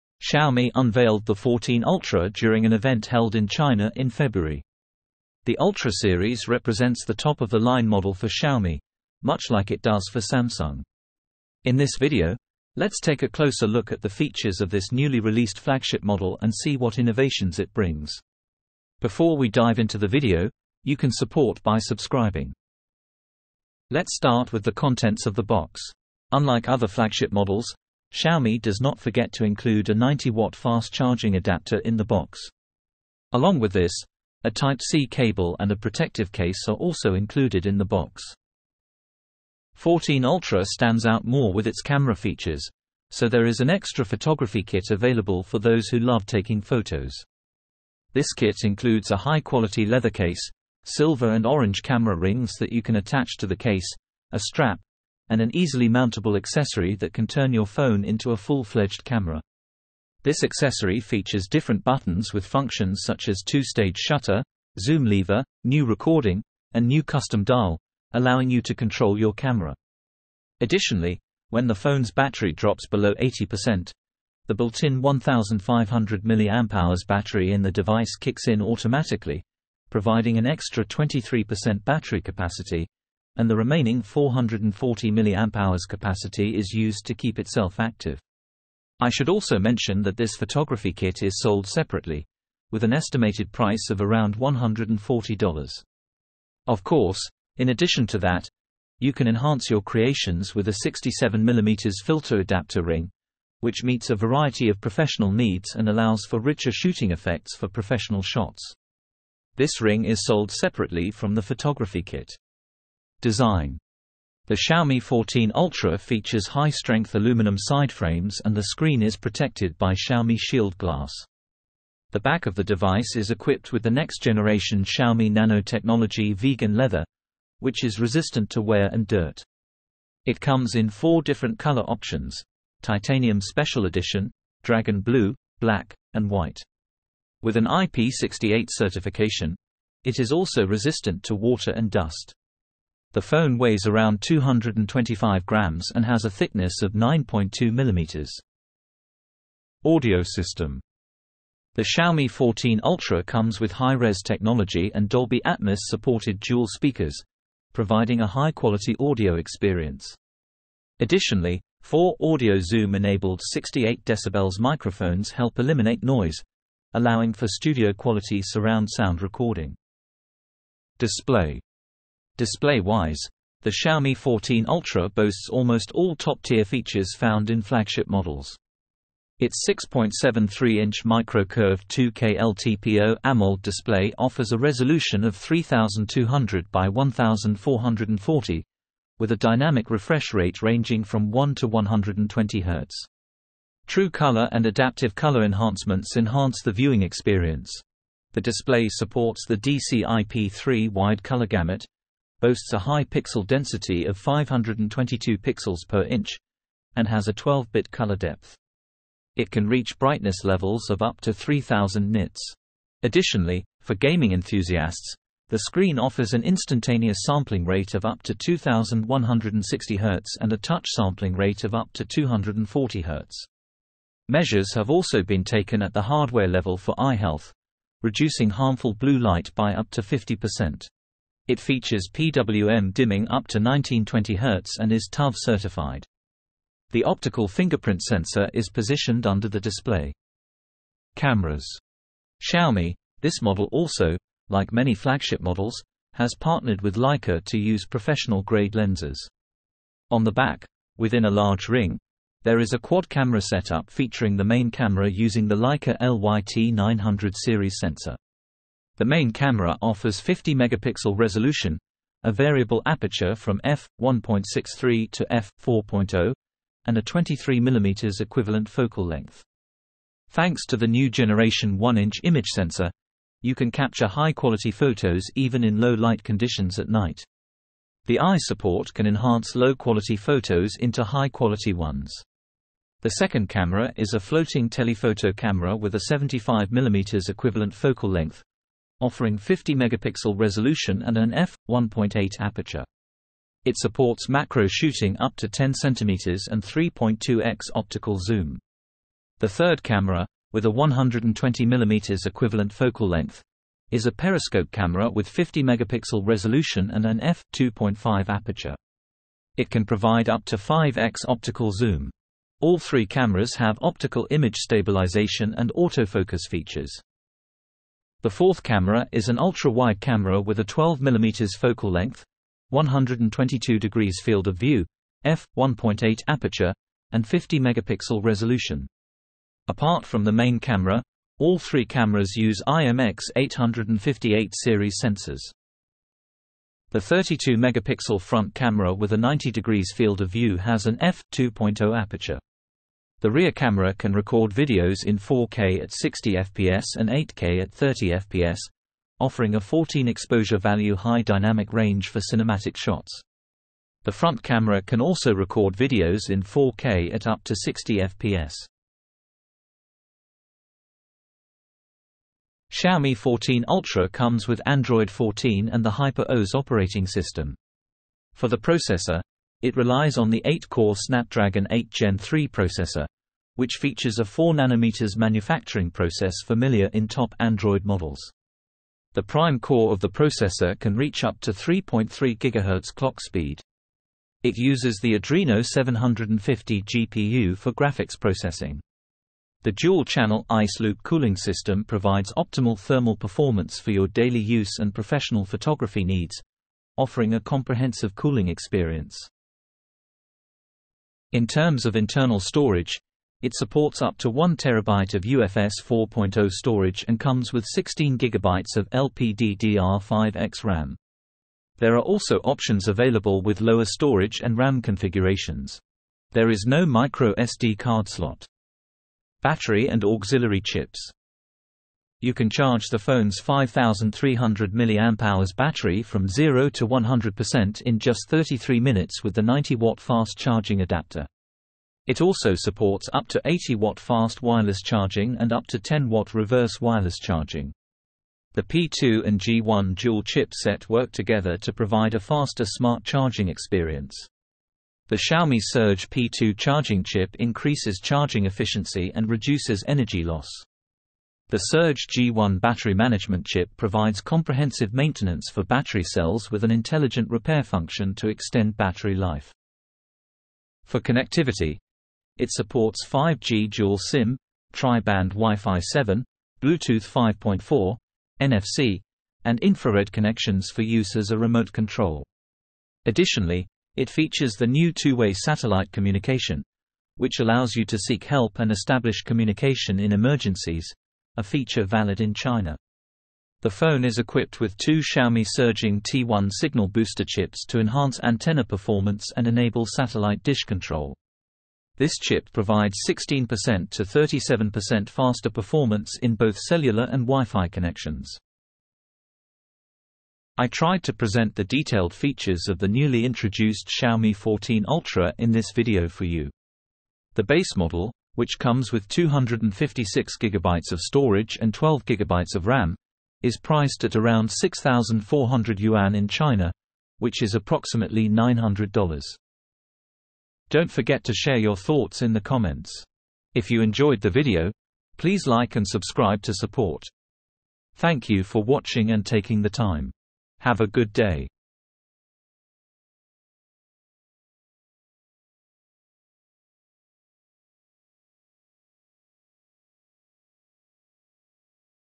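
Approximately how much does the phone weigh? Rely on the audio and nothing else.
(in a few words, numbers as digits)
225 grams.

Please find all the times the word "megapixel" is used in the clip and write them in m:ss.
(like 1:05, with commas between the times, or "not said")
4:20, 4:49, 5:05, 5:27, 5:37.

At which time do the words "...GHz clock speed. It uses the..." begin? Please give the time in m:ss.
6:22.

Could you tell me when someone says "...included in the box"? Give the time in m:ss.
0:37.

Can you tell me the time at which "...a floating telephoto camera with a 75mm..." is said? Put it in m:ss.
4:44.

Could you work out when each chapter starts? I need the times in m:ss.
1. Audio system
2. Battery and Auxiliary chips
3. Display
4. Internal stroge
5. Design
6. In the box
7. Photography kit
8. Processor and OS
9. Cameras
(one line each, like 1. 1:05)
1. 2:29
2. 6:58
3. 2:49
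4. 6:40
5. 1:52
6. 0:23
7. 0:39
8. 6:01
9. 4:00.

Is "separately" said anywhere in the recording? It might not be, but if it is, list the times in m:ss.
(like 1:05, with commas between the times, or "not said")
1:31, 1:50.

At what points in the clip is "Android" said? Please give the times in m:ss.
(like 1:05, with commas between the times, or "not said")
6:04, 6:17.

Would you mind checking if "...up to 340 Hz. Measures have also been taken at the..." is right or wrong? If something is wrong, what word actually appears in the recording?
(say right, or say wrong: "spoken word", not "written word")
wrong: "240", not "340".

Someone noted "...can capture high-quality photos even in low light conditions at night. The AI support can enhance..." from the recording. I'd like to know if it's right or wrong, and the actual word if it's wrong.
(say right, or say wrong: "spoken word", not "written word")
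right.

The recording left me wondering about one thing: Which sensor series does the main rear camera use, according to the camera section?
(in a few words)
Leica LYT900.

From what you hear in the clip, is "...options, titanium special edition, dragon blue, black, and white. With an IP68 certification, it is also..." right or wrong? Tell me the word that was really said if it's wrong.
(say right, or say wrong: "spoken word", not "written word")
right.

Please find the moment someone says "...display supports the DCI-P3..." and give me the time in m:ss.
3:18.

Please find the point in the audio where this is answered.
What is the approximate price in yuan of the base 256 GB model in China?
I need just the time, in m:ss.
8:34.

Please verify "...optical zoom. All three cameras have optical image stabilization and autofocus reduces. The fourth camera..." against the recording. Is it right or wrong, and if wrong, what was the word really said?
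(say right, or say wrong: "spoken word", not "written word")
wrong: "features", not "reduces".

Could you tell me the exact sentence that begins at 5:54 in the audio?
The front camera can also record videos in 4K at up to 60 fps.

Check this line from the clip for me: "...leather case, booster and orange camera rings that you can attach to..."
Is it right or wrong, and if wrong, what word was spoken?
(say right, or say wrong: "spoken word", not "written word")
wrong: "silver", not "booster".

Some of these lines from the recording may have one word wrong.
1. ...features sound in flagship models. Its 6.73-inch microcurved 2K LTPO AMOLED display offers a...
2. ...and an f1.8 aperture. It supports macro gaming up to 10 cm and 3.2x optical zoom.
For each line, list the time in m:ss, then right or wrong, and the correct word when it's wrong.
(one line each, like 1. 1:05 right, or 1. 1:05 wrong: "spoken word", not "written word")
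1. 2:56 wrong: "found", not "sound"
2. 4:51 wrong: "shooting", not "gaming".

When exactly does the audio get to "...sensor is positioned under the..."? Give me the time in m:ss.
3:58.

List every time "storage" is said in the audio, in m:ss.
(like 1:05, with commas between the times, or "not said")
6:42, 6:46, 6:53, 8:31.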